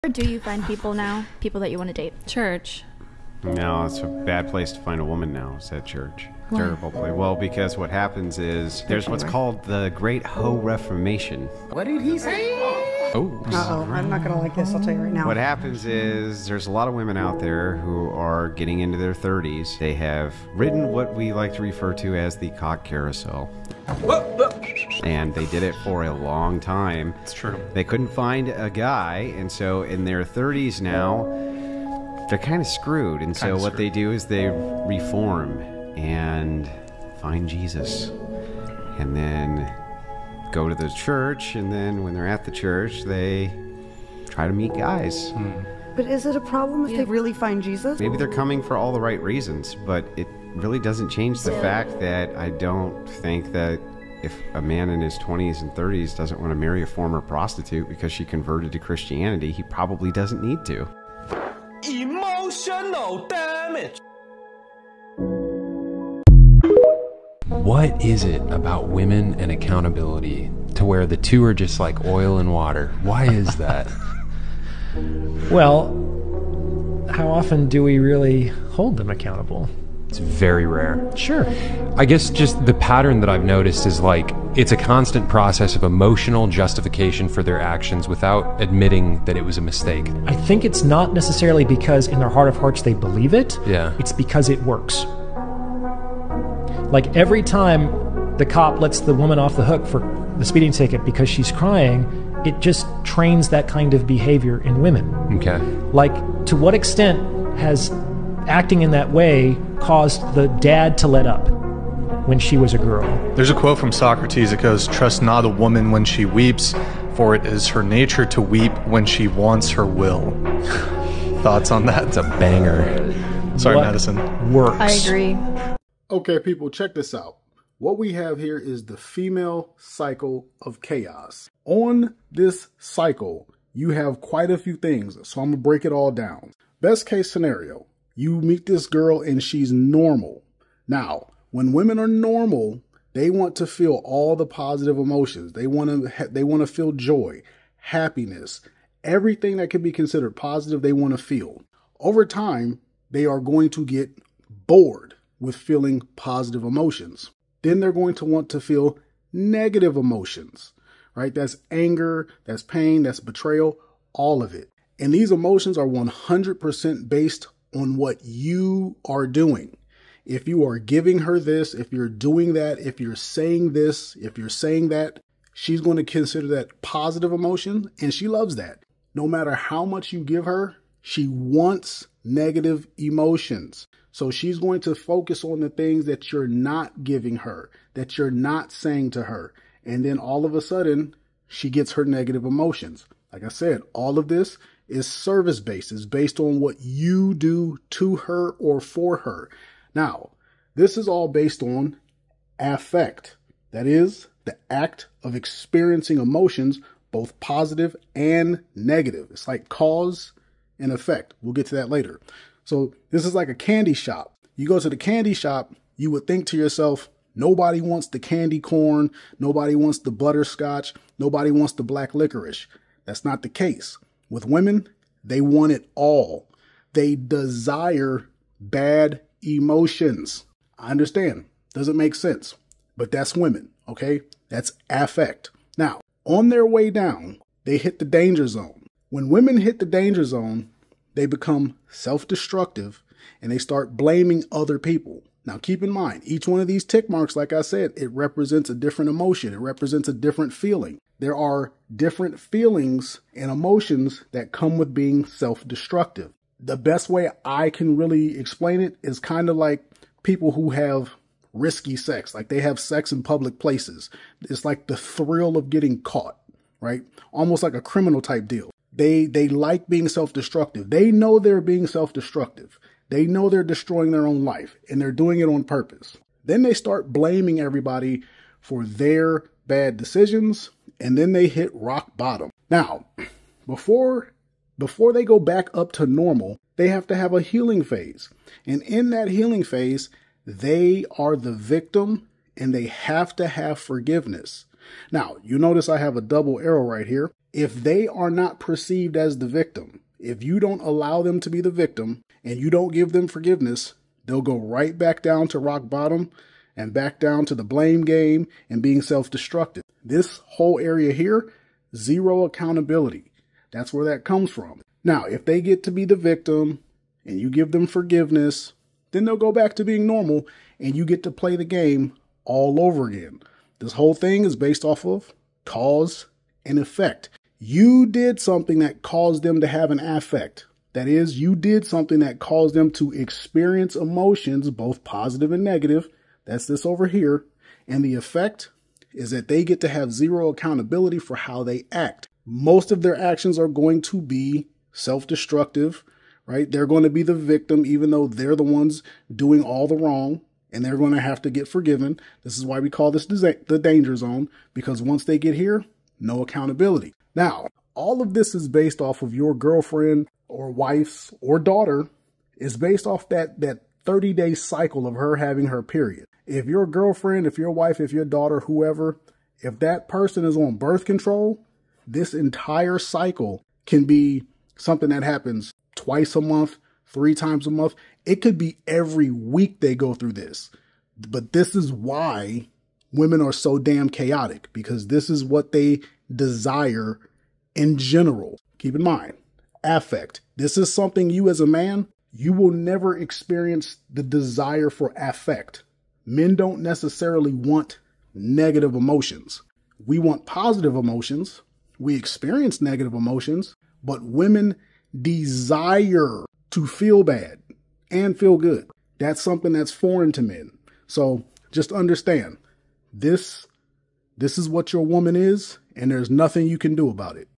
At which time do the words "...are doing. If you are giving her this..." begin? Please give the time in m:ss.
2:49.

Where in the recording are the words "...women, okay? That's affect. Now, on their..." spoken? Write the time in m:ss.
3:53.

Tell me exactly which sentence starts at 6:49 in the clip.
That's something that's foreign to men.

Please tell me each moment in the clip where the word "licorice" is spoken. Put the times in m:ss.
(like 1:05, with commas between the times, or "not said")
3:42.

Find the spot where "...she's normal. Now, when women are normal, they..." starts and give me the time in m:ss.
2:19.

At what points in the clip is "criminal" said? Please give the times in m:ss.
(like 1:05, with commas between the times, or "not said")
4:27.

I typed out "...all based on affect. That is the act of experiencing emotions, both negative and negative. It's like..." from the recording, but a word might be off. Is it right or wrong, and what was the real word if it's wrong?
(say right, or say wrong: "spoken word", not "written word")
wrong: "positive", not "negative".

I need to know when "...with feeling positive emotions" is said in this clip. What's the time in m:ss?
2:35.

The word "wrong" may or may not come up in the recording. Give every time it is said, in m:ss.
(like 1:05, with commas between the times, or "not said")
5:49.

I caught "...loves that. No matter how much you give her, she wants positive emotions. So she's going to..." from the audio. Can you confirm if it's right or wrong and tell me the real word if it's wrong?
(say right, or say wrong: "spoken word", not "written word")
wrong: "negative", not "positive".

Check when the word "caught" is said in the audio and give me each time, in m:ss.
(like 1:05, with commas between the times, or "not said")
4:26.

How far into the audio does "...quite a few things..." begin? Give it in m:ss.
2:14.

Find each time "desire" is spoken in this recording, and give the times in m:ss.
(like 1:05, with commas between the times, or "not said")
3:47, 6:26, 6:34, 6:45.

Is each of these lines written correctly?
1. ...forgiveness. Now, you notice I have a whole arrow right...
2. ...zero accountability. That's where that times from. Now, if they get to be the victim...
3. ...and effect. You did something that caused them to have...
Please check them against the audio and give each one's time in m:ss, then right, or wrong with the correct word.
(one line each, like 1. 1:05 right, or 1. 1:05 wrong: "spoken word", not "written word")
1. 4:53 wrong: "double", not "whole"
2. 5:11 wrong: "comes", not "times"
3. 5:26 right.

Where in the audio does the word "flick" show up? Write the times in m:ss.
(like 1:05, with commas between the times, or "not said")
not said.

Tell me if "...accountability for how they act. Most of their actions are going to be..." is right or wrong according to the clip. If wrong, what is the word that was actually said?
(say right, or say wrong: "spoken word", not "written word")
right.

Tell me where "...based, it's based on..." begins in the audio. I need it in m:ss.
3:15.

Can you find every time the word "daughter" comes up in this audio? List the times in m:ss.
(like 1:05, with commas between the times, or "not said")
6:01, 6:08.